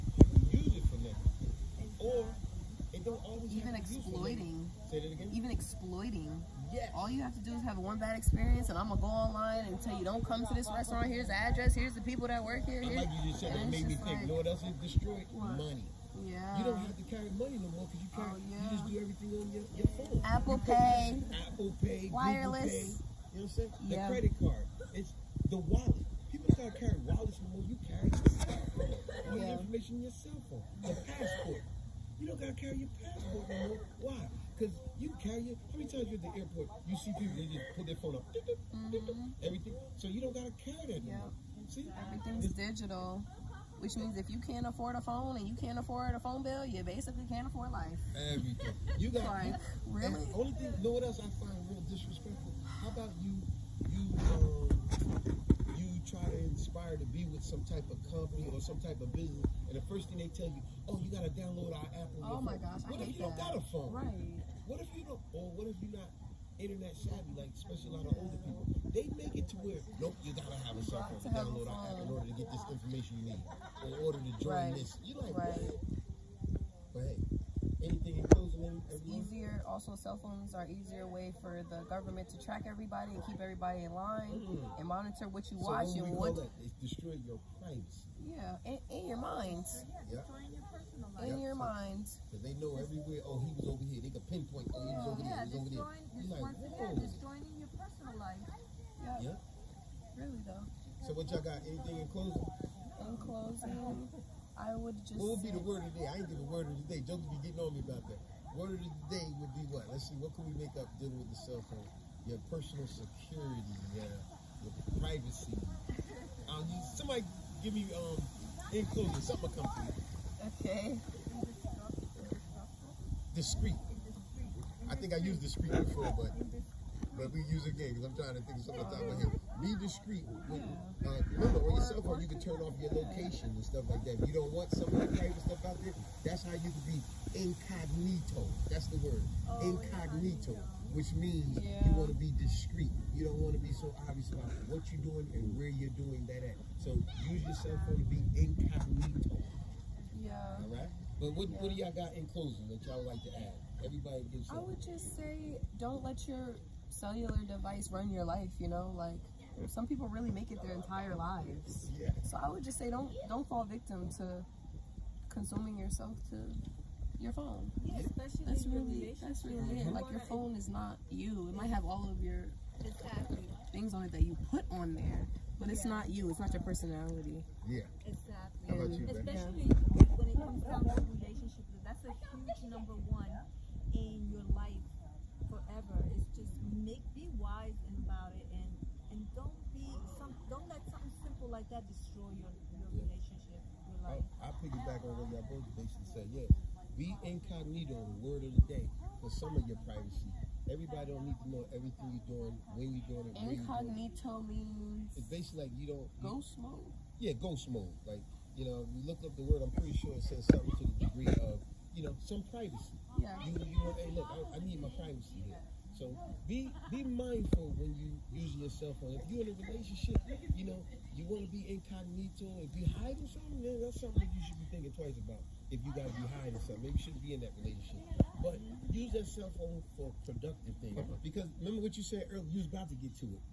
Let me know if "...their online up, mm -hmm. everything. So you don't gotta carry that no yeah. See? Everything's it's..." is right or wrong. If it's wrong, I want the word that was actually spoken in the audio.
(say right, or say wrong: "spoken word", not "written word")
wrong: "phone", not "online".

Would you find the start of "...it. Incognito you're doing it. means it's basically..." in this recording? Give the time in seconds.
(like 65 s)
203 s.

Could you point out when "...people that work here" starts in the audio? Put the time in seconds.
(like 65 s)
12 s.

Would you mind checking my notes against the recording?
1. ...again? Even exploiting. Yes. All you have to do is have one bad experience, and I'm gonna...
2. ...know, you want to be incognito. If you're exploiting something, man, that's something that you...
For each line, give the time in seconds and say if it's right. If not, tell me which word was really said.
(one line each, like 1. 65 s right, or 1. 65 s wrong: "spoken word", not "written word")
1. 5 s right
2. 220 s wrong: "hiding", not "exploiting".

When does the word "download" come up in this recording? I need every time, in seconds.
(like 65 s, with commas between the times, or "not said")
61 s, 71 s.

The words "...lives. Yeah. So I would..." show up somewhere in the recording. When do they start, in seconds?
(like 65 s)
161 s.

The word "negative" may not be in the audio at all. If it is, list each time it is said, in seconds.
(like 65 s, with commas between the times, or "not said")
0 s.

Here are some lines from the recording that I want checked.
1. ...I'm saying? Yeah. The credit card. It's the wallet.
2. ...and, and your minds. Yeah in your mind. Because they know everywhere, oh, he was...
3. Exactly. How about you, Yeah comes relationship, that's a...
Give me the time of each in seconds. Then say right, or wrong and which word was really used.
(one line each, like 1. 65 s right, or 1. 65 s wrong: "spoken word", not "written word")
1. 23 s right
2. 88 s right
3. 178 s wrong: "Especially", not "Yeah".